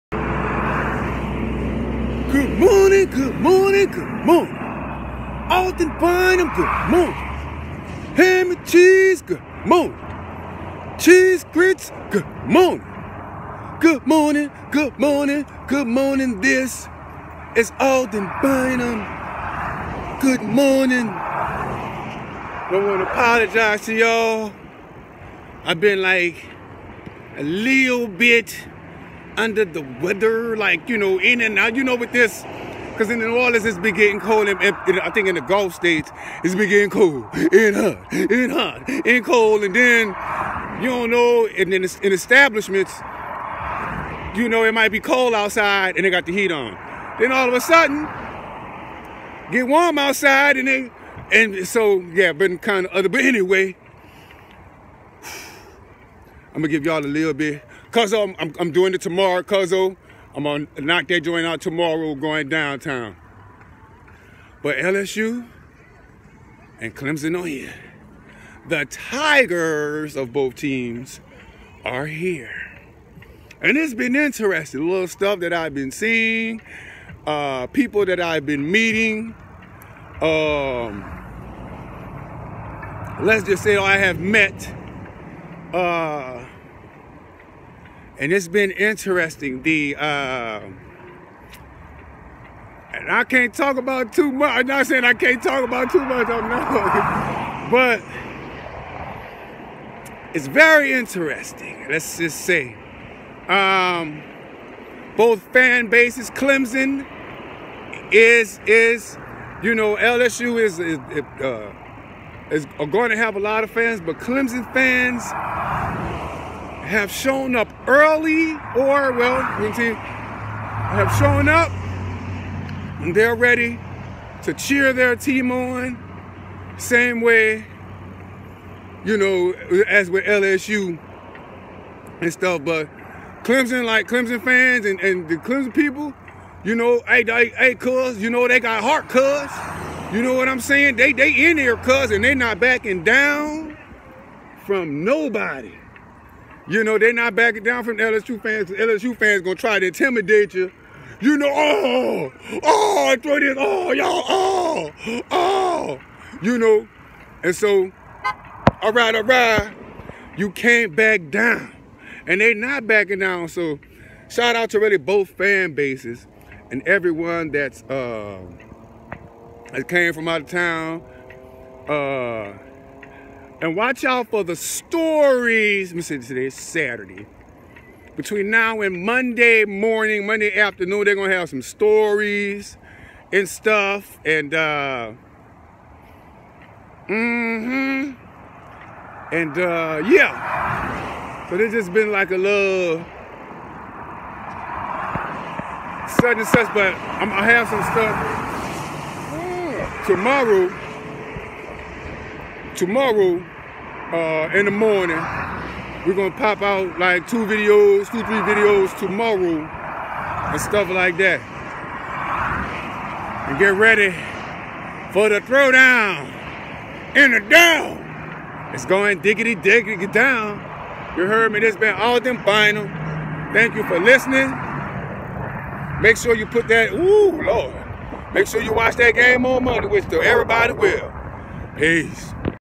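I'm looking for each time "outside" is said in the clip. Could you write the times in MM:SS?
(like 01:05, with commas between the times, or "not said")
00:45, 00:49.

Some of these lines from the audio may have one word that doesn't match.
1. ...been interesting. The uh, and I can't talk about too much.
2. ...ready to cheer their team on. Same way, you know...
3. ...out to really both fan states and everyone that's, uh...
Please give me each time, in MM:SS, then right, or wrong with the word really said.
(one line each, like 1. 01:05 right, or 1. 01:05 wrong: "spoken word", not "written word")
1. 01:28 right
2. 02:03 right
3. 02:44 wrong: "bases", not "states".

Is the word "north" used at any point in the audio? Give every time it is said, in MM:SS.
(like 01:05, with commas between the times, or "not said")
not said.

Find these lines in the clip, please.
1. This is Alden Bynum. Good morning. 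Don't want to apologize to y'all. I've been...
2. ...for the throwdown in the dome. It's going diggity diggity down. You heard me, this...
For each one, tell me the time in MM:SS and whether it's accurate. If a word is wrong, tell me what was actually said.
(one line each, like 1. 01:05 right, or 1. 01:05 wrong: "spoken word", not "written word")
1. 00:16 right
2. 03:35 right.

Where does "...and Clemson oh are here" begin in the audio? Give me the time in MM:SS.
01:06.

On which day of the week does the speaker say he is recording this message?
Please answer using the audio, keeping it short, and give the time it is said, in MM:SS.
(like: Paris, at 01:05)
Saturday, at 02:56.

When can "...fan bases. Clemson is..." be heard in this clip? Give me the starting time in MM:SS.
01:45.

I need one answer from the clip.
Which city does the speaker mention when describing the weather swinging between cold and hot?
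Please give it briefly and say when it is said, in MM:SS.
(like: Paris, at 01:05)
New Orleans, at 00:33.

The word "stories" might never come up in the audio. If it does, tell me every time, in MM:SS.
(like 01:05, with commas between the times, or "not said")
02:54, 03:01.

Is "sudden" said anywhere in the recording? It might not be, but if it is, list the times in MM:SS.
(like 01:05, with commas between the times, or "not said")
00:47, 03:16.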